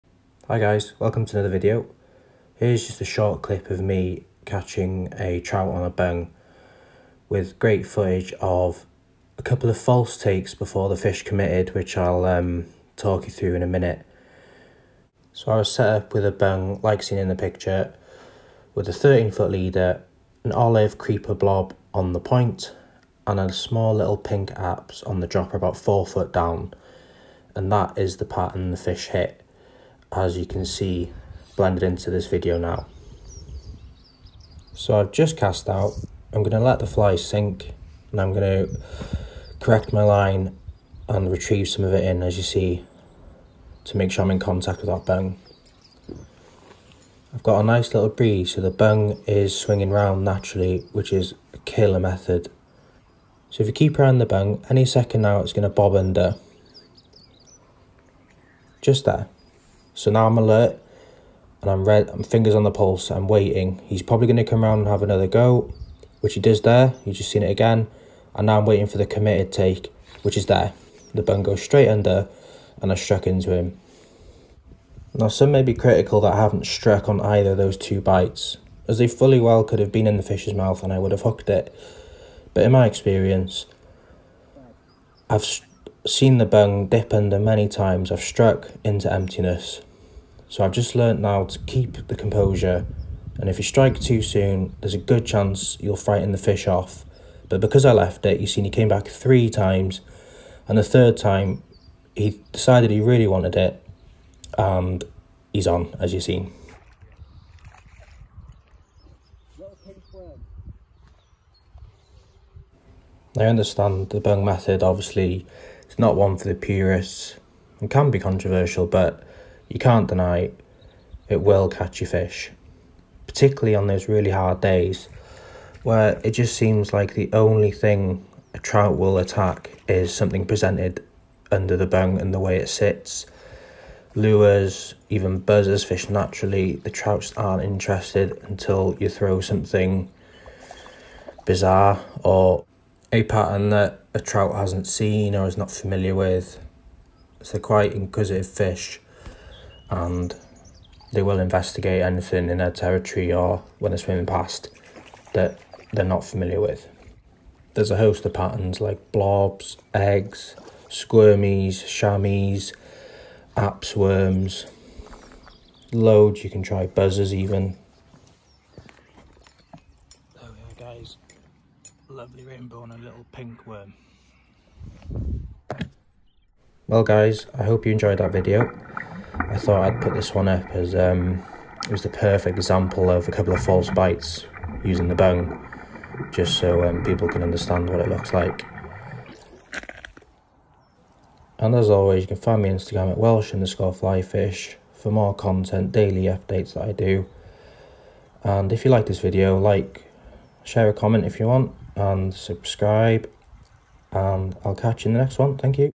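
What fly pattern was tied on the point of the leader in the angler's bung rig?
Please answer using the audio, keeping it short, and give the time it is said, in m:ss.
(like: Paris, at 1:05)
olive creeper blob, at 0:20.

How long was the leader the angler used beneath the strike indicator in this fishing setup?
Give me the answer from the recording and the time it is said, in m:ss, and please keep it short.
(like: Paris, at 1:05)
13 foot, at 0:18.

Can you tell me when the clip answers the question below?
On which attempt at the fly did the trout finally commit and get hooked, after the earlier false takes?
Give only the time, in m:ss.
1:40.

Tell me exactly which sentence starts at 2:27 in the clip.
So quite inquisitive fish and they will investigate anything in their territory or when they're swimming past that they're not familiar with.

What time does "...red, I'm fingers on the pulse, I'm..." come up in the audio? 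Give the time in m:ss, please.
1:01.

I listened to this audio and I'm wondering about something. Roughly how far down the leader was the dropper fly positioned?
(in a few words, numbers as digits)
4 foot.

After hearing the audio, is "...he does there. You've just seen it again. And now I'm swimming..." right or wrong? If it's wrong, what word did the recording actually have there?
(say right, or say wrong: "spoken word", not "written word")
wrong: "waiting", not "swimming".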